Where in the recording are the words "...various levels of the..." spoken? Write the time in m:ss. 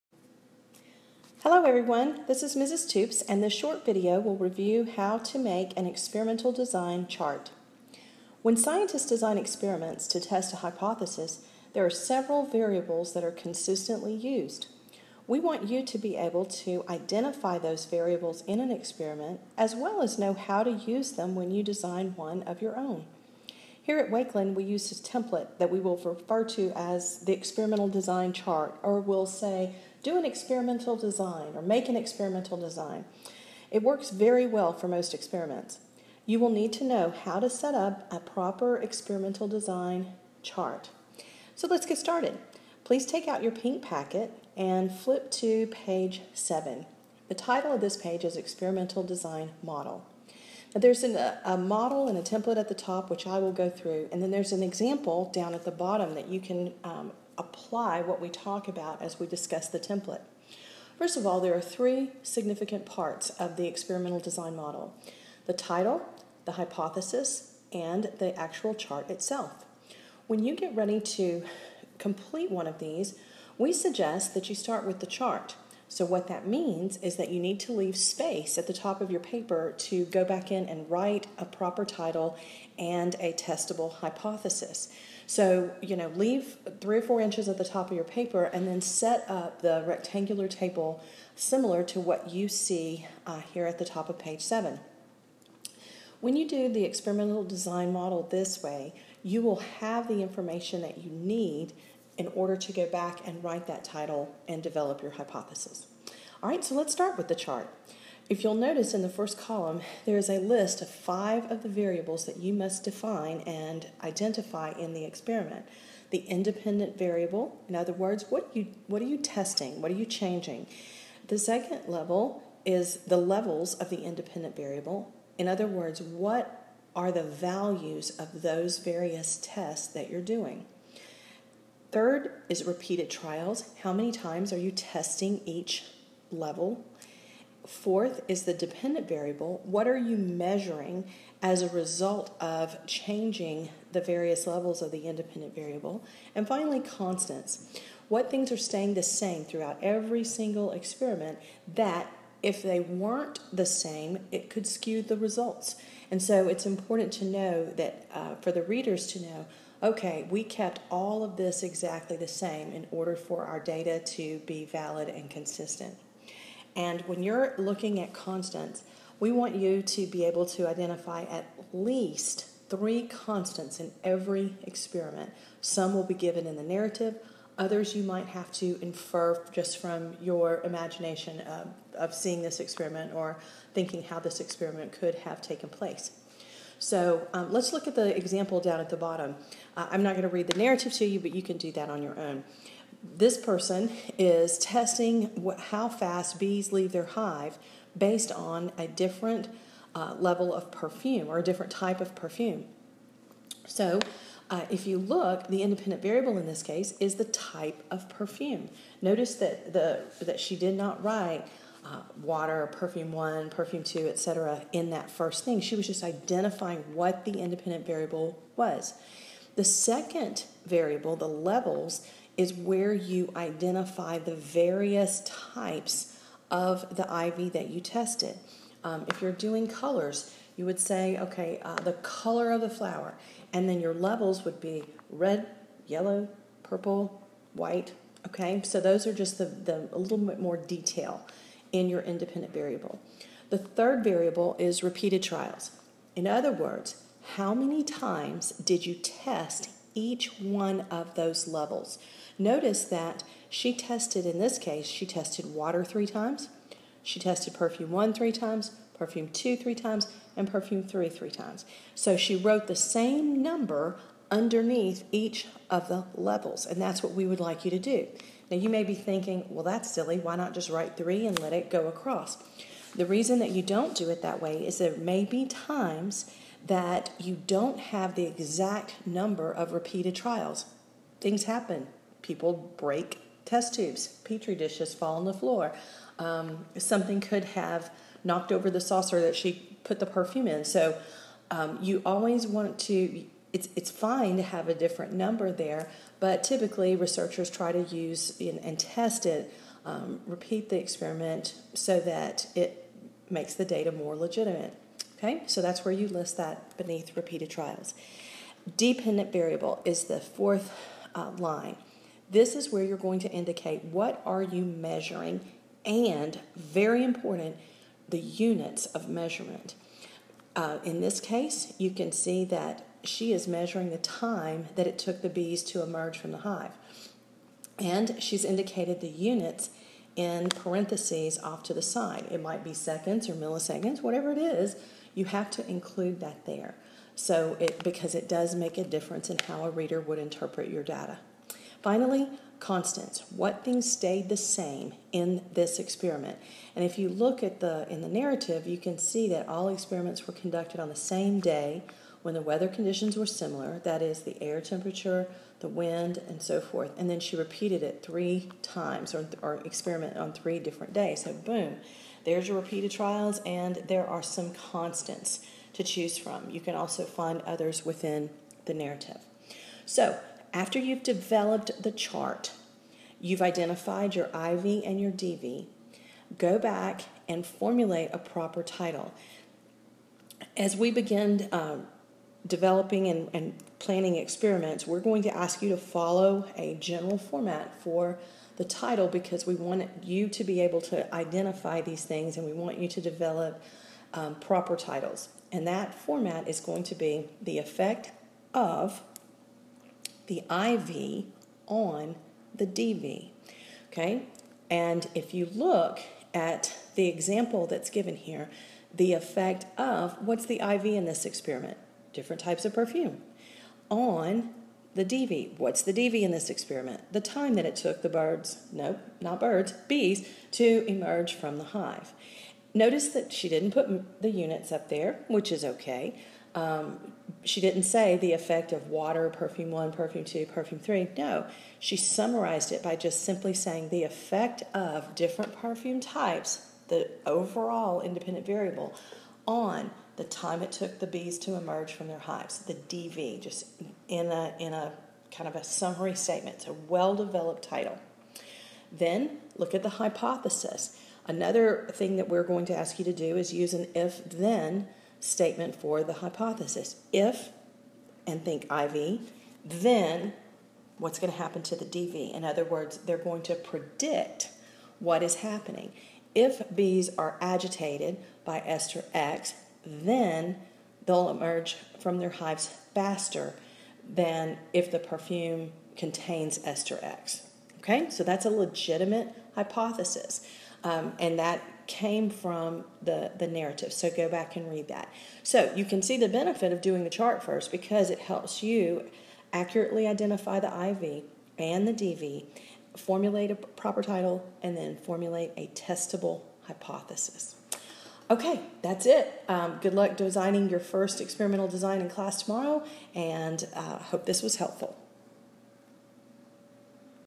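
2:24.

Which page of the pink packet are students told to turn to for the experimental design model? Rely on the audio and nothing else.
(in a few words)
7.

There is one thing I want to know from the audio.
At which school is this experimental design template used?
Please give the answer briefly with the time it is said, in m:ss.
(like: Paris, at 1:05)
Wakeland, at 0:24.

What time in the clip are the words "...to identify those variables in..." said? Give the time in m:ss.
0:16.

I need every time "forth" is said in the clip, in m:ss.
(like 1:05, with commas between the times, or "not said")
5:56.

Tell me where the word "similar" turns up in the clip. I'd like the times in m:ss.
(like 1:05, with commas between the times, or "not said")
1:31, 5:53.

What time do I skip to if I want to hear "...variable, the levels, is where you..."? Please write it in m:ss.
3:40.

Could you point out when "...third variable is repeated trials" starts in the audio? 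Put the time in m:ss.
4:03.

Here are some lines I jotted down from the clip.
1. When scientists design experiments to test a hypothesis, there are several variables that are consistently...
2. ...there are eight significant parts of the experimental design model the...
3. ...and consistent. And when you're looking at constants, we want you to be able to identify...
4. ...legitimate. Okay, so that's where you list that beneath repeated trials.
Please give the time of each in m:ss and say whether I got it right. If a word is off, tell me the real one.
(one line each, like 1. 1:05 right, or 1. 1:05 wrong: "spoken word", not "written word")
1. 0:08 right
2. 1:01 wrong: "three", not "eight"
3. 2:45 right
4. 5:04 right.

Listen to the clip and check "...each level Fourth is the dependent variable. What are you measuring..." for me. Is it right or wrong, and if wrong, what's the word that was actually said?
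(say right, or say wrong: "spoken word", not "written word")
right.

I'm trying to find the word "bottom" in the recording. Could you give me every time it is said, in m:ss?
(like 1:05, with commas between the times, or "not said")
0:55, 3:08.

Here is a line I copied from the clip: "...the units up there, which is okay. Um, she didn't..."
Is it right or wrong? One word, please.
right.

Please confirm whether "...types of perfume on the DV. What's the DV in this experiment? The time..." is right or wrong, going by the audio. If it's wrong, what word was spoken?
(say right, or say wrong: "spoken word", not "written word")
right.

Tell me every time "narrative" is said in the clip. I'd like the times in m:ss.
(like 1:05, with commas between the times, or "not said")
2:56, 3:10, 5:48, 6:08, 8:03.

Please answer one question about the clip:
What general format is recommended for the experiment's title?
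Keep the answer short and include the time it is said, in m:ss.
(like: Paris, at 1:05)
The effect of the IV on the DV, at 6:37.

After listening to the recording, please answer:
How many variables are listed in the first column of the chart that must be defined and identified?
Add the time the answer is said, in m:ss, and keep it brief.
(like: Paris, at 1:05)
5, at 1:50.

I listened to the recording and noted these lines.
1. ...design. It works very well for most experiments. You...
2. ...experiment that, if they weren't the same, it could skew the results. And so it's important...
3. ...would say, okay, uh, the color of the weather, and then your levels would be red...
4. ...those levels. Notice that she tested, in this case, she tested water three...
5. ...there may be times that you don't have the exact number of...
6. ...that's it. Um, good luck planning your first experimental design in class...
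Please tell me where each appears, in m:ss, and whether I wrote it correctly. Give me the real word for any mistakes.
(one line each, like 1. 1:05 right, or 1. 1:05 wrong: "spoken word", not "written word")
1. 0:32 right
2. 2:30 right
3. 3:50 wrong: "flower", not "weather"
4. 4:11 right
5. 4:34 right
6. 8:18 wrong: "designing", not "planning".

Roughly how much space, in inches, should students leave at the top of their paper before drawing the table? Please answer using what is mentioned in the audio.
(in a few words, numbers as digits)
3 or 4 inches.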